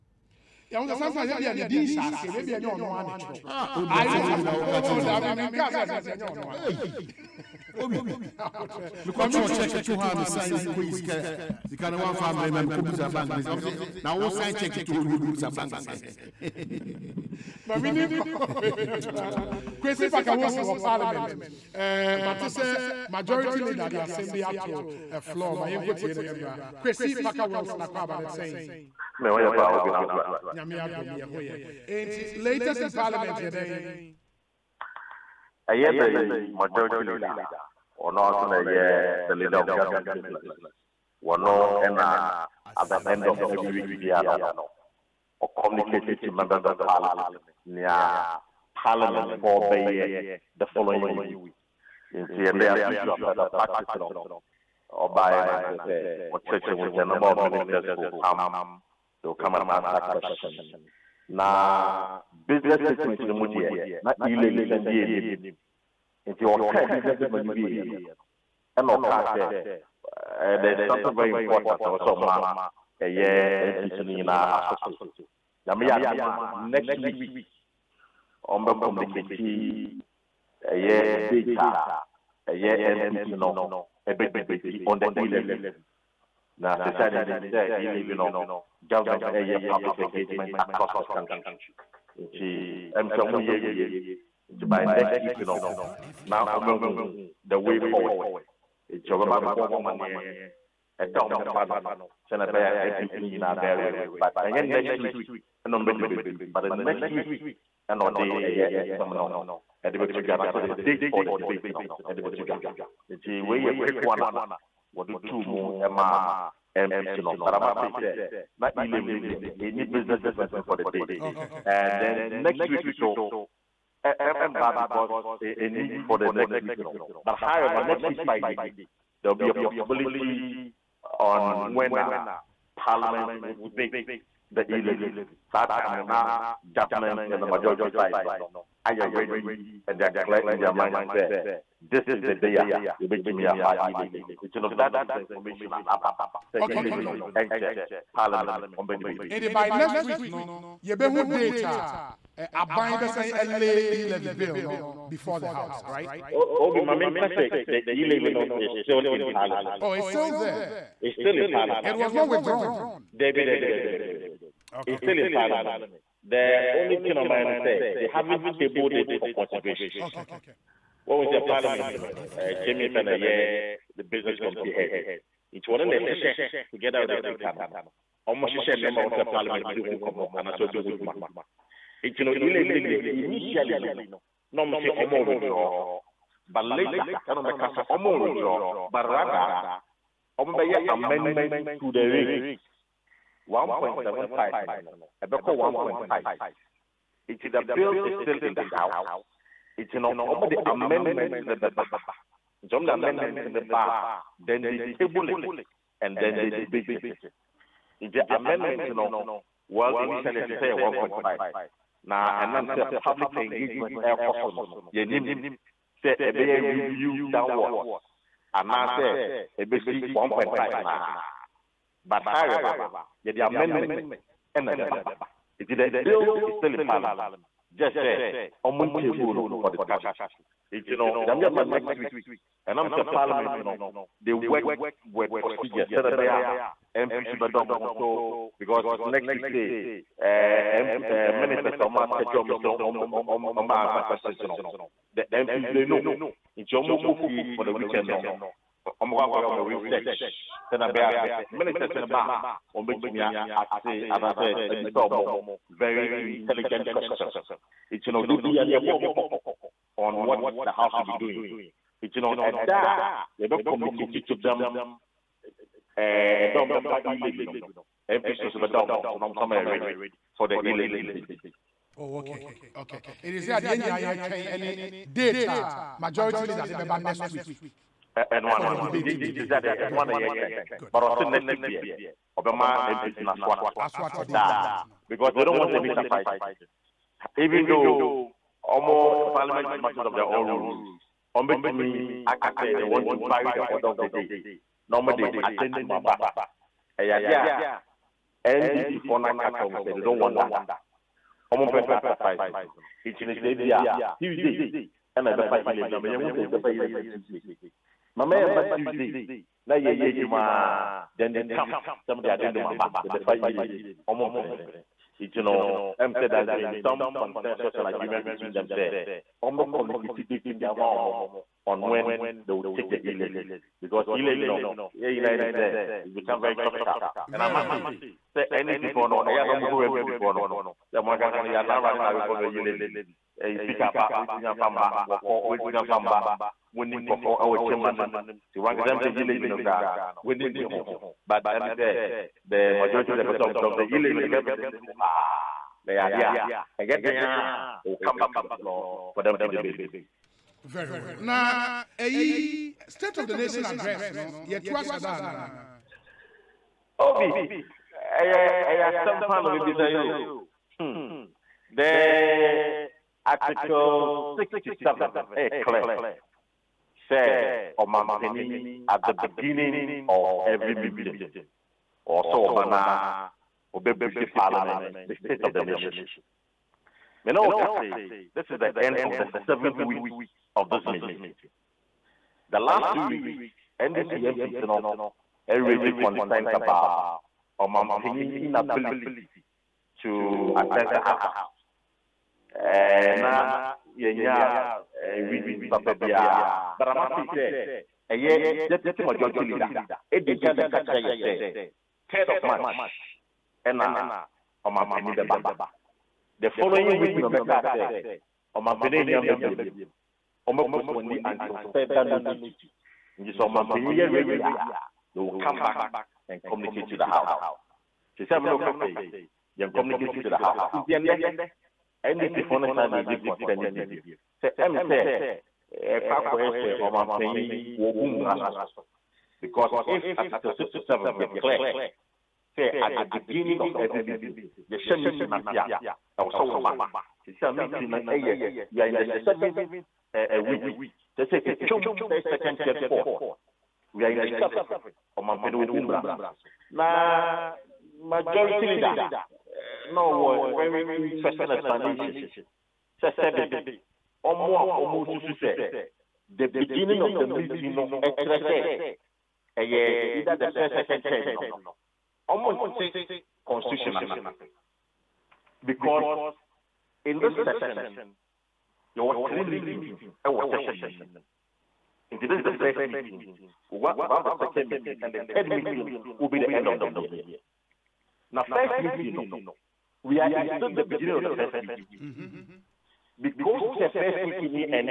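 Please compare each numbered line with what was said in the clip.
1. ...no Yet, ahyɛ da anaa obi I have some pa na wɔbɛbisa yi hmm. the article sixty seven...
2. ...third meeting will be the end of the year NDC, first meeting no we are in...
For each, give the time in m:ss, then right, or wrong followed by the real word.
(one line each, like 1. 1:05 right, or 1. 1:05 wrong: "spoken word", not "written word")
1. 5:54 right
2. 7:55 wrong: "Now", not "NDC".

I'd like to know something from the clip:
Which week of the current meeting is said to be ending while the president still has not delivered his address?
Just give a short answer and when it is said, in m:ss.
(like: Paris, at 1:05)
Seventh week, at 6:19.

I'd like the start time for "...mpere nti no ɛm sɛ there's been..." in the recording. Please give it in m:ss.
5:14.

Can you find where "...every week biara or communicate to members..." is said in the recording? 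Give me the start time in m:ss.
0:43.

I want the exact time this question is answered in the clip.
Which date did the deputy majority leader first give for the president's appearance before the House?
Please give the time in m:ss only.
6:41.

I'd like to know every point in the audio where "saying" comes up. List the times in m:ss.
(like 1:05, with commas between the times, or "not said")
3:32, 3:52.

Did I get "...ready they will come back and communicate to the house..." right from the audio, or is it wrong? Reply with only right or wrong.
right.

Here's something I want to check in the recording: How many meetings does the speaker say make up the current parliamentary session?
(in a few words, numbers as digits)
3.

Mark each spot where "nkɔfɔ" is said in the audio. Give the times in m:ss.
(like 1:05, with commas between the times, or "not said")
5:37.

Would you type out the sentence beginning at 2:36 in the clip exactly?
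obi my nka sɛ the e-levy no is still in parliament.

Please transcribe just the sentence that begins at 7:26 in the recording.
So now majority leader uh, no a very interesting explanation.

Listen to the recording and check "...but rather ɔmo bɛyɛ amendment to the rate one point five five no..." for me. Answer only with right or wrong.
wrong.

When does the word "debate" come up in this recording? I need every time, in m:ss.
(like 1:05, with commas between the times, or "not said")
1:24, 1:51, 2:13, 2:28, 3:26, 4:30, 5:49.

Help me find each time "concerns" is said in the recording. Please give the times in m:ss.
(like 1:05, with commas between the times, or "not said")
6:25, 7:03.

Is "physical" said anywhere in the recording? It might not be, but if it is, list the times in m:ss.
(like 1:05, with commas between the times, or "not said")
not said.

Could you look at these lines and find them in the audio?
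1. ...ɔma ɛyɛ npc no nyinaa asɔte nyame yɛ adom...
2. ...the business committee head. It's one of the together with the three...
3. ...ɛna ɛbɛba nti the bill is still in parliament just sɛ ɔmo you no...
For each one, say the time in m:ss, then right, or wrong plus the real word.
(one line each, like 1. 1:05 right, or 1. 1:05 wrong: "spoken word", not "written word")
1. 1:12 right
2. 2:53 wrong: "two", not "three"
3. 3:44 right.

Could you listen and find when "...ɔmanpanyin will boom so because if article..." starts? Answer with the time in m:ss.
7:06.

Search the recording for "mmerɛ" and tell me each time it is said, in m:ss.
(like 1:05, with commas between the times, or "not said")
0:12.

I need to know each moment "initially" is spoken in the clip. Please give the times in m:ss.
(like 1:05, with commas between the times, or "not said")
3:03, 3:29.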